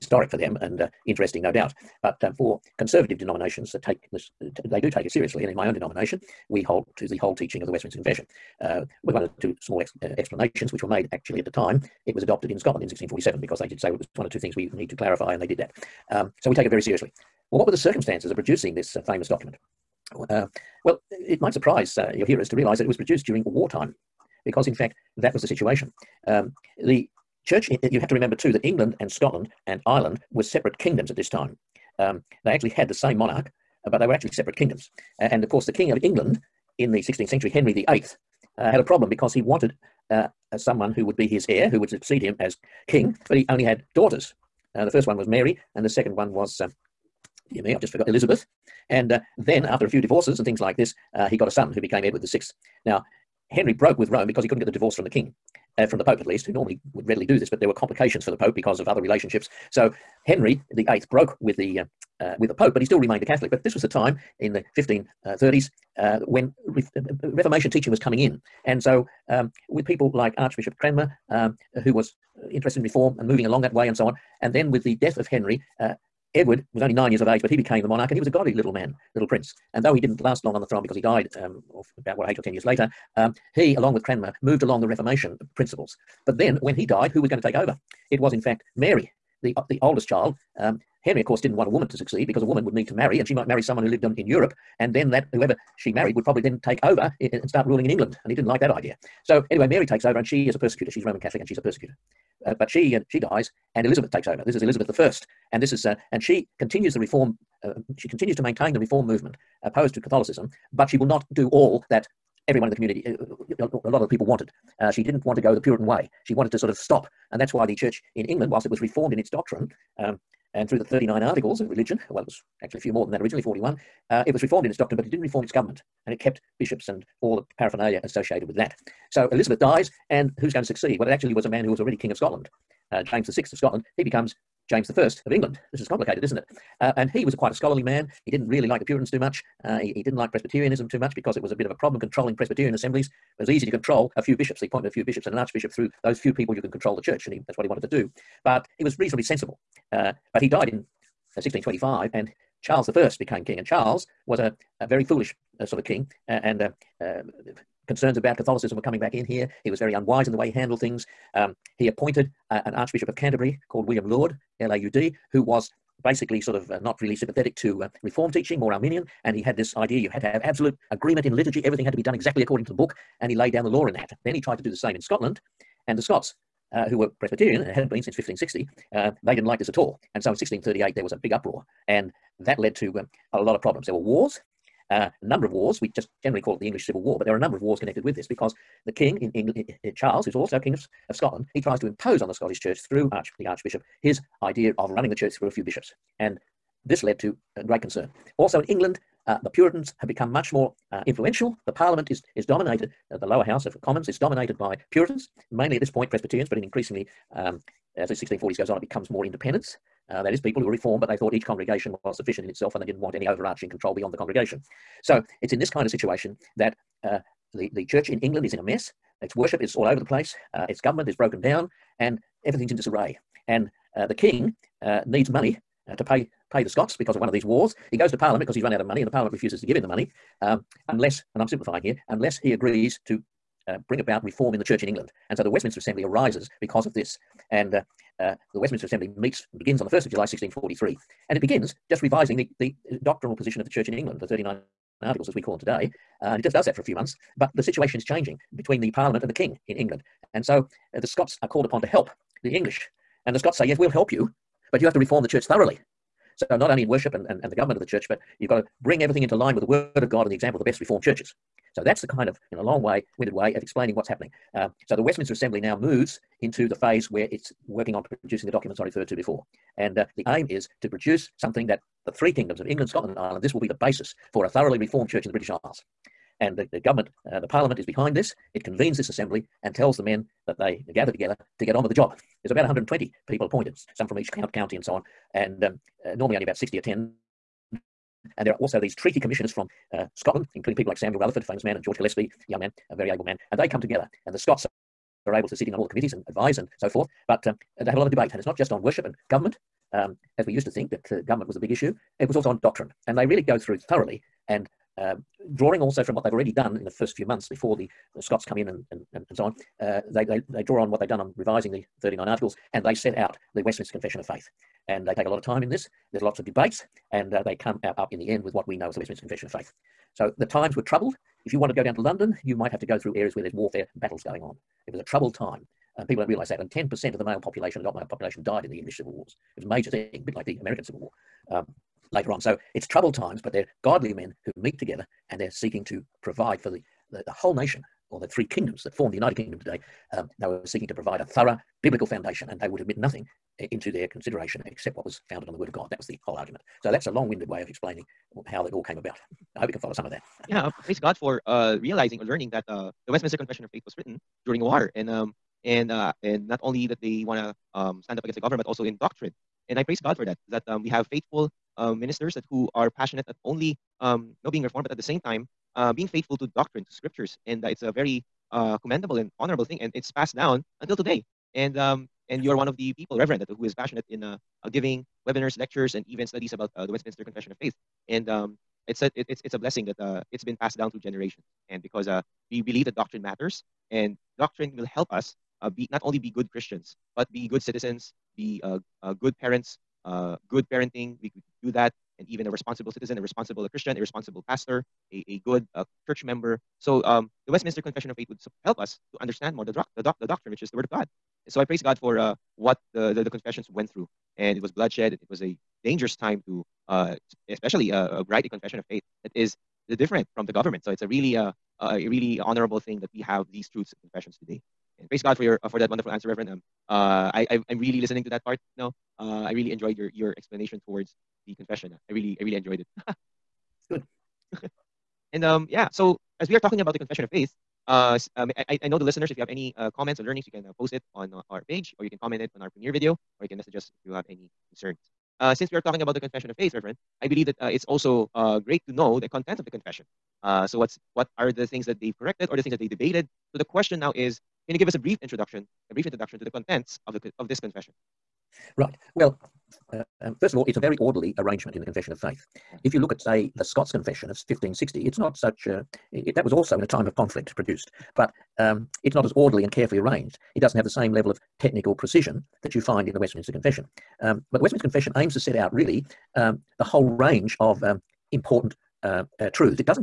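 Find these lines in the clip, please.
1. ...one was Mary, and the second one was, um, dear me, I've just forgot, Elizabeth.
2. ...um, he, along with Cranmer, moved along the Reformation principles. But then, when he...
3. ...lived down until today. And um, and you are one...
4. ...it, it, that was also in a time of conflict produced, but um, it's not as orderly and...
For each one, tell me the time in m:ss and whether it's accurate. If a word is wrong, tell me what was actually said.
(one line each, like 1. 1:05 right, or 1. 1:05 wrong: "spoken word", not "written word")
1. 0:45 right
2. 1:23 right
3. 6:10 wrong: "passed", not "lived"
4. 7:36 right.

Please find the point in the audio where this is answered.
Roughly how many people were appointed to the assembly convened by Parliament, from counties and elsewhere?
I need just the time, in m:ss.
4:42.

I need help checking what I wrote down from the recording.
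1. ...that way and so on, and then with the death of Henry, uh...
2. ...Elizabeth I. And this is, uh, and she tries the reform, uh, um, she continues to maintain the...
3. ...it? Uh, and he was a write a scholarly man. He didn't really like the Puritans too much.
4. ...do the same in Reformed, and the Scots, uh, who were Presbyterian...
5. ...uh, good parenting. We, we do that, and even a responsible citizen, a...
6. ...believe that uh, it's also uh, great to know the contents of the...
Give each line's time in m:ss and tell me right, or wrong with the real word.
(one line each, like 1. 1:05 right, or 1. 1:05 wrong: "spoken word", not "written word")
1. 1:13 right
2. 1:44 wrong: "continues", not "tries"
3. 2:16 wrong: "quite", not "write"
4. 2:54 wrong: "Scotland", not "Reformed"
5. 6:30 right
6. 7:17 right.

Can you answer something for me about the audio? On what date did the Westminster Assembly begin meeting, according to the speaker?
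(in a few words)
1 July 1643.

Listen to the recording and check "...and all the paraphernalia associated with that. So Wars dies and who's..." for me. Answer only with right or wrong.
wrong.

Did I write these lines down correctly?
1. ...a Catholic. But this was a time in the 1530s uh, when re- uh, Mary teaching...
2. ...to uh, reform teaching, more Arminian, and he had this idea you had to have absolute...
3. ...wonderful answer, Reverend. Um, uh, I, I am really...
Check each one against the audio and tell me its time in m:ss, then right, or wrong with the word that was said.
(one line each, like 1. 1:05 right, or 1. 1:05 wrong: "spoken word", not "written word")
1. 1:03 wrong: "Reformation", not "Mary"
2. 2:47 right
3. 6:55 right.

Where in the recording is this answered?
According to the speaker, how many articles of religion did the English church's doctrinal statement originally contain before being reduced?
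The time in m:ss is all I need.
2:03.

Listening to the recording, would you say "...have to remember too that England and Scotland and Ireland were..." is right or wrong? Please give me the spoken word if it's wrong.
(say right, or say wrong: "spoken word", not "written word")
right.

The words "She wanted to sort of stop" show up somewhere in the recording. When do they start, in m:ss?
1:56.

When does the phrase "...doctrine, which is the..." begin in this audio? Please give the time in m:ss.
6:40.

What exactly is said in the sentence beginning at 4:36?
And the, the government, uh, the parliament is behind this.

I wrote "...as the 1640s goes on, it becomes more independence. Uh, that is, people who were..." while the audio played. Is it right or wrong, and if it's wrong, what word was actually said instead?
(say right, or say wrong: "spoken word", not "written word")
right.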